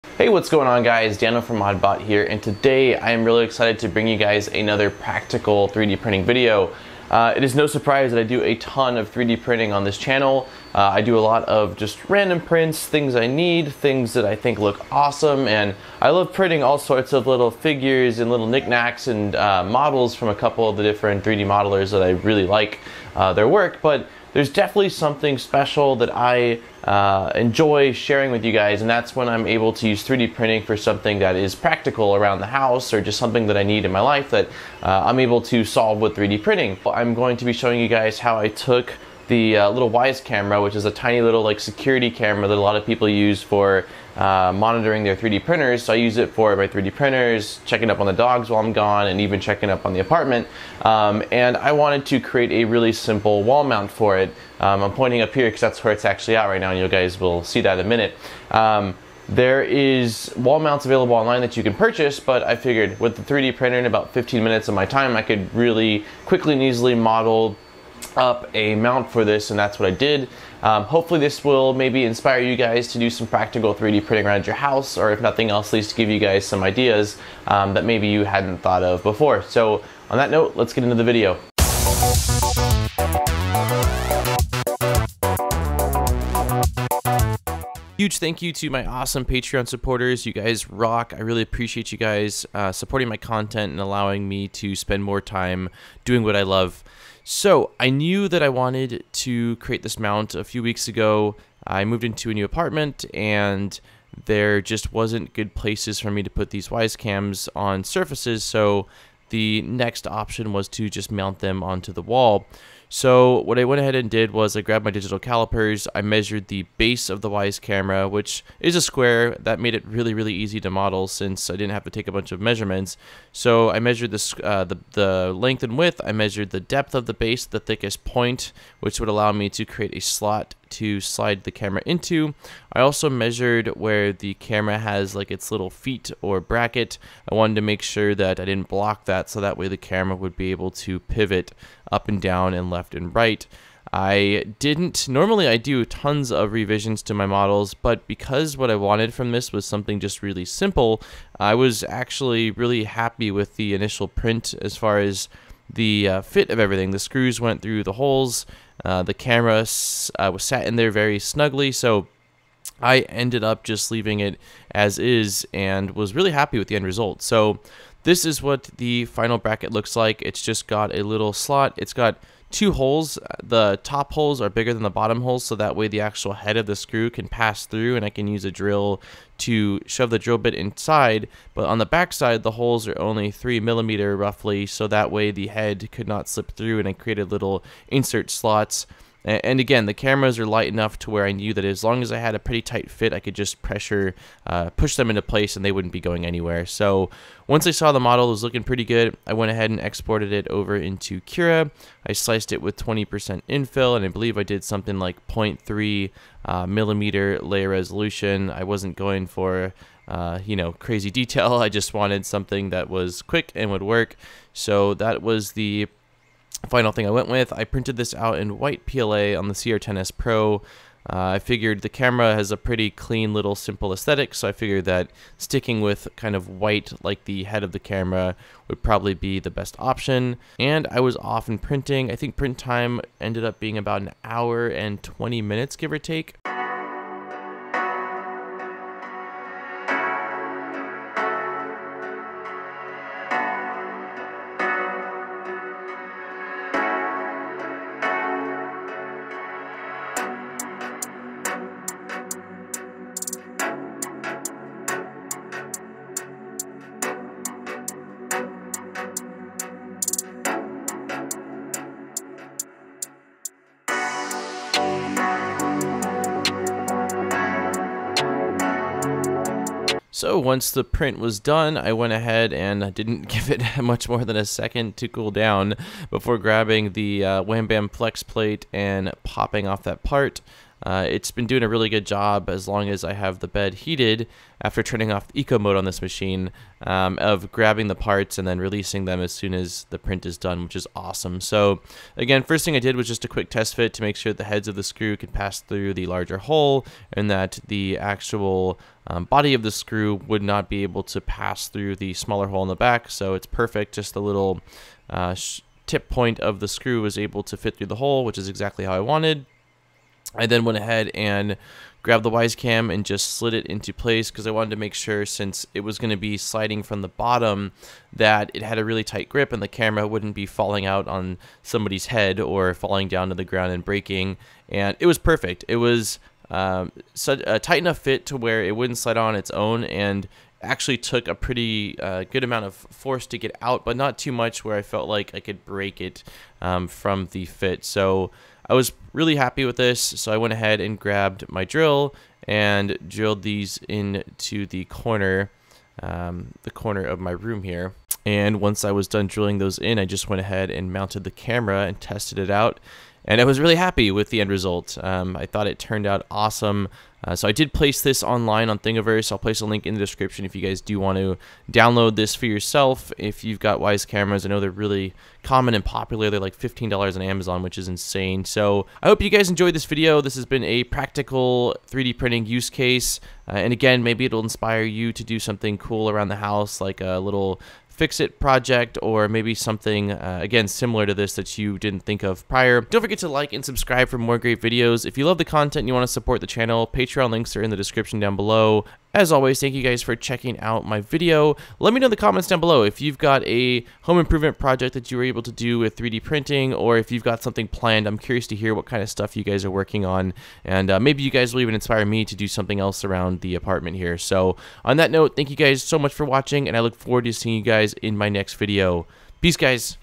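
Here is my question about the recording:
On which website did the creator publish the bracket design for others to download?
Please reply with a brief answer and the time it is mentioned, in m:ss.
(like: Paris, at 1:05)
Thingiverse, at 5:58.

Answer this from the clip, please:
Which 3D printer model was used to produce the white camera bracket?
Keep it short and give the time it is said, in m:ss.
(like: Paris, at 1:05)
CR10S Pro, at 3:39.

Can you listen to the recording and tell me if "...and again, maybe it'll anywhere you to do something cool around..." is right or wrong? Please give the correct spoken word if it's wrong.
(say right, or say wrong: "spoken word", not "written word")
wrong: "inspire", not "anywhere".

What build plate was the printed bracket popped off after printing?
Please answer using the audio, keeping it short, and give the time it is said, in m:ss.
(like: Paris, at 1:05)
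Wham Bam Plex plate, at 4:37.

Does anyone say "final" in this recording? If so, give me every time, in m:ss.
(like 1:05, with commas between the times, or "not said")
2:49, 3:36.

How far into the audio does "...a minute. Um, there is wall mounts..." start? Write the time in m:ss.
0:57.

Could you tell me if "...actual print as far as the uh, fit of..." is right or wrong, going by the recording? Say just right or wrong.
wrong.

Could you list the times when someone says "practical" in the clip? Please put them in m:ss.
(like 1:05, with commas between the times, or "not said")
0:04, 0:31, 1:13, 6:10.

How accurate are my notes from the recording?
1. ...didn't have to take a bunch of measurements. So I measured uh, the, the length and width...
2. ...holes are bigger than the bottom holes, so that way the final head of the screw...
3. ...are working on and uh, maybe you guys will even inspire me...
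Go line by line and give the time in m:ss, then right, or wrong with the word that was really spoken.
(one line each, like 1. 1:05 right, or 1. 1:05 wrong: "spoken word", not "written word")
1. 2:01 right
2. 2:54 wrong: "actual", not "final"
3. 6:39 right.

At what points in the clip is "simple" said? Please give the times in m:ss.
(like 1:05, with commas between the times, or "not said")
0:52, 2:30, 3:43.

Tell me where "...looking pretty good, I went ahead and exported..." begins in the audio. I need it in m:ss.
3:18.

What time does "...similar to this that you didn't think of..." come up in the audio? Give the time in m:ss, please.
6:20.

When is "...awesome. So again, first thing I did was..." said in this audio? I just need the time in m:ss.
4:50.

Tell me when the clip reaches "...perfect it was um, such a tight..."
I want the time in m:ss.
5:25.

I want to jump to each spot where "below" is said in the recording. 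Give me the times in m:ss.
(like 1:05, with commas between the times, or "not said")
6:28, 6:32.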